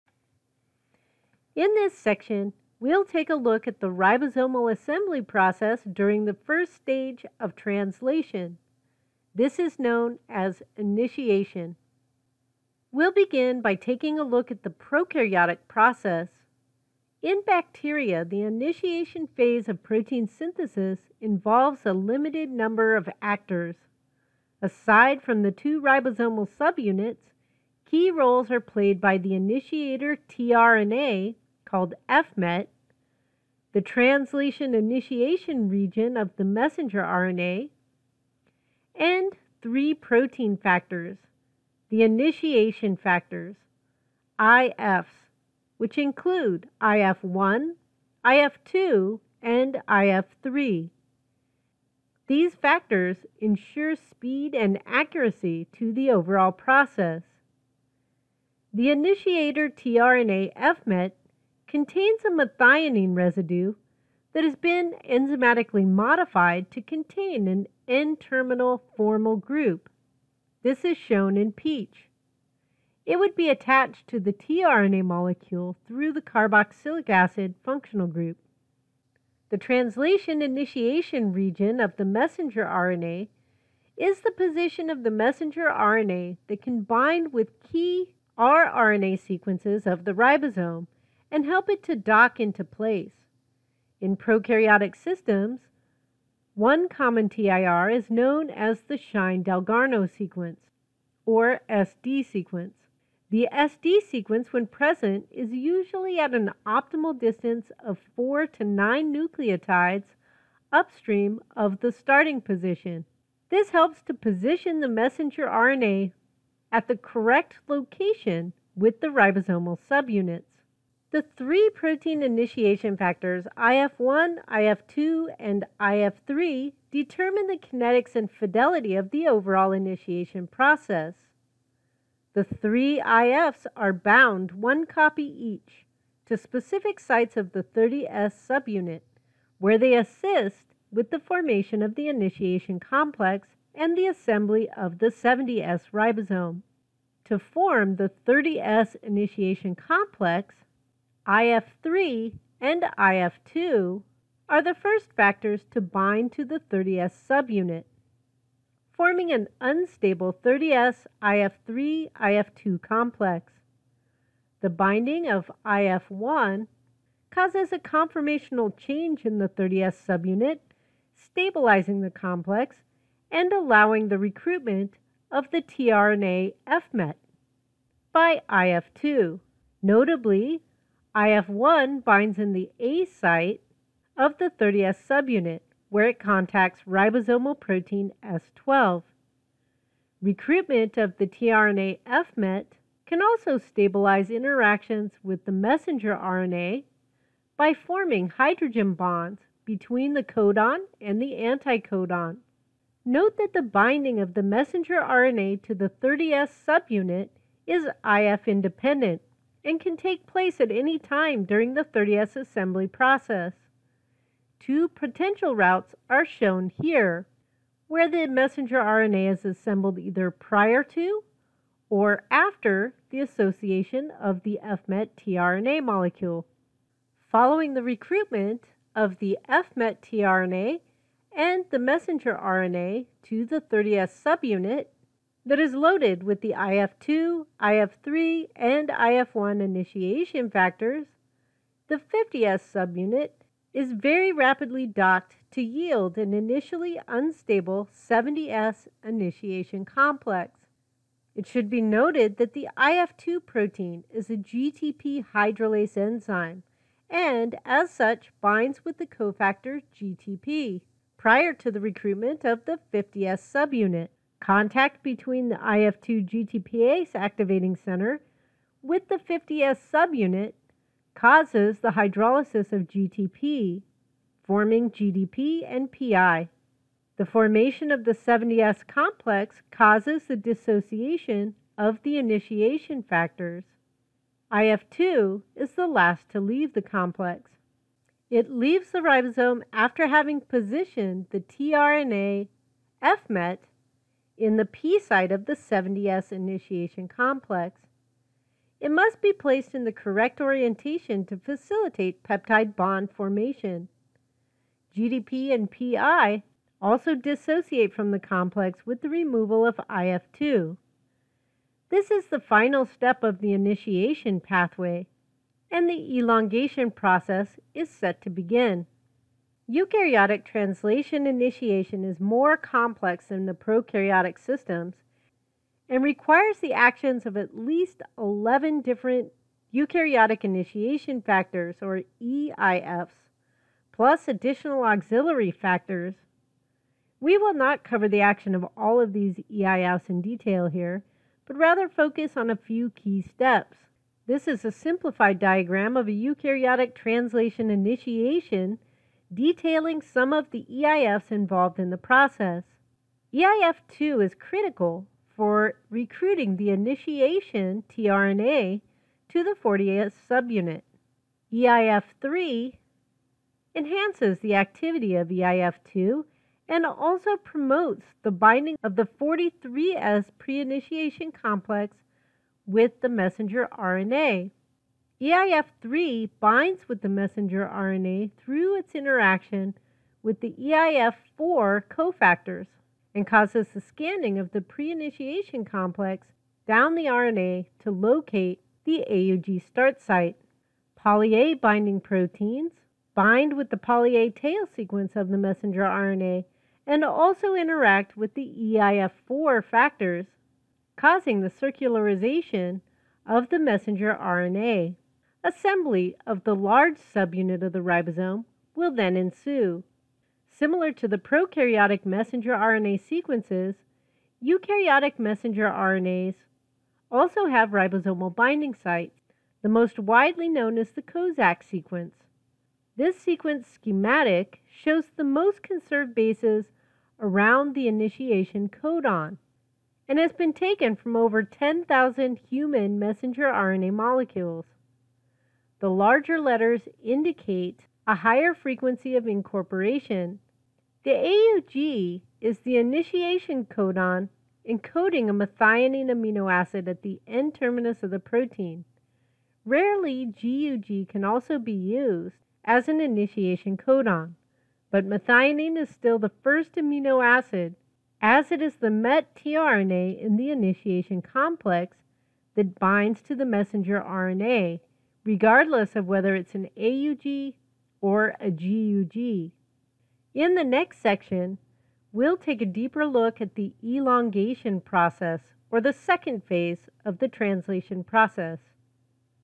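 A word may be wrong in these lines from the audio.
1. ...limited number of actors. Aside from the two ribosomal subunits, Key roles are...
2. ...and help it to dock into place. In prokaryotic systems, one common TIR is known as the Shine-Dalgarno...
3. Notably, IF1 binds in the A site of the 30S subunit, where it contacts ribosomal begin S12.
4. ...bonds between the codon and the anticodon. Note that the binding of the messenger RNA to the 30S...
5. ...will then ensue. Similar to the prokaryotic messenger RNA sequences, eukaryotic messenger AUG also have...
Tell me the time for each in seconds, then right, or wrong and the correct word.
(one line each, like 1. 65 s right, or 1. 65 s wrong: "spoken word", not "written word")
1. 21 s right
2. 91 s right
3. 179 s wrong: "protein", not "begin"
4. 198 s right
5. 408 s wrong: "RNAs", not "AUG".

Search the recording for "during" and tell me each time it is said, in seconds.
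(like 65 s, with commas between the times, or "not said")
5 s, 211 s.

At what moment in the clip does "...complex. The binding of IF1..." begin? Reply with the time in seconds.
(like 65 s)
162 s.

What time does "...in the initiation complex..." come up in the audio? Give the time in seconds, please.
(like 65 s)
460 s.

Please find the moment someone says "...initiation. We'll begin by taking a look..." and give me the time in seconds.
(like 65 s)
10 s.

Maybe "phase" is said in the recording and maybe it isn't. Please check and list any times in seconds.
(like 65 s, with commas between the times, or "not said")
19 s, 476 s.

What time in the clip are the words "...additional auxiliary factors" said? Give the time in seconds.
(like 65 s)
334 s.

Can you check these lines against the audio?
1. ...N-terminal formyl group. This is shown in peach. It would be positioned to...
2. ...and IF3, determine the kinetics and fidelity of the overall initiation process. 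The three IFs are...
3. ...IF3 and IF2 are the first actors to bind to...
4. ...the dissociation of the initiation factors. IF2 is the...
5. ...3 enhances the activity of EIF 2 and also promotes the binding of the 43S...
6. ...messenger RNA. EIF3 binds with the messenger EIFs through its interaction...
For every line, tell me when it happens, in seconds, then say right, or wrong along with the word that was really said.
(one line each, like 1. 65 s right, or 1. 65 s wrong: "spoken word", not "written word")
1. 67 s wrong: "attached", not "positioned"
2. 125 s right
3. 151 s wrong: "factors", not "actors"
4. 280 s right
5. 362 s right
6. 373 s wrong: "RNA", not "EIFs".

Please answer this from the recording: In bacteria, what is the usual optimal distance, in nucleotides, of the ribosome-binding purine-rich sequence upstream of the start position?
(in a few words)
4 to 9.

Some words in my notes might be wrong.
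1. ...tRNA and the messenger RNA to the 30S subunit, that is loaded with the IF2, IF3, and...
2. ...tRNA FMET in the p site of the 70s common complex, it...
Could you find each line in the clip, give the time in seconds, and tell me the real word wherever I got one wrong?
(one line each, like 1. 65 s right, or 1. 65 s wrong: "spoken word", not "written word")
1. 230 s right
2. 291 s wrong: "initiation", not "common".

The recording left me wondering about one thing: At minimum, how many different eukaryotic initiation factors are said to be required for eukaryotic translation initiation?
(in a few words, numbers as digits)
11.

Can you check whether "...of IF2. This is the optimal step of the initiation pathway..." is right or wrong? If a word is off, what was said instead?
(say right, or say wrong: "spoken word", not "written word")
wrong: "final", not "optimal".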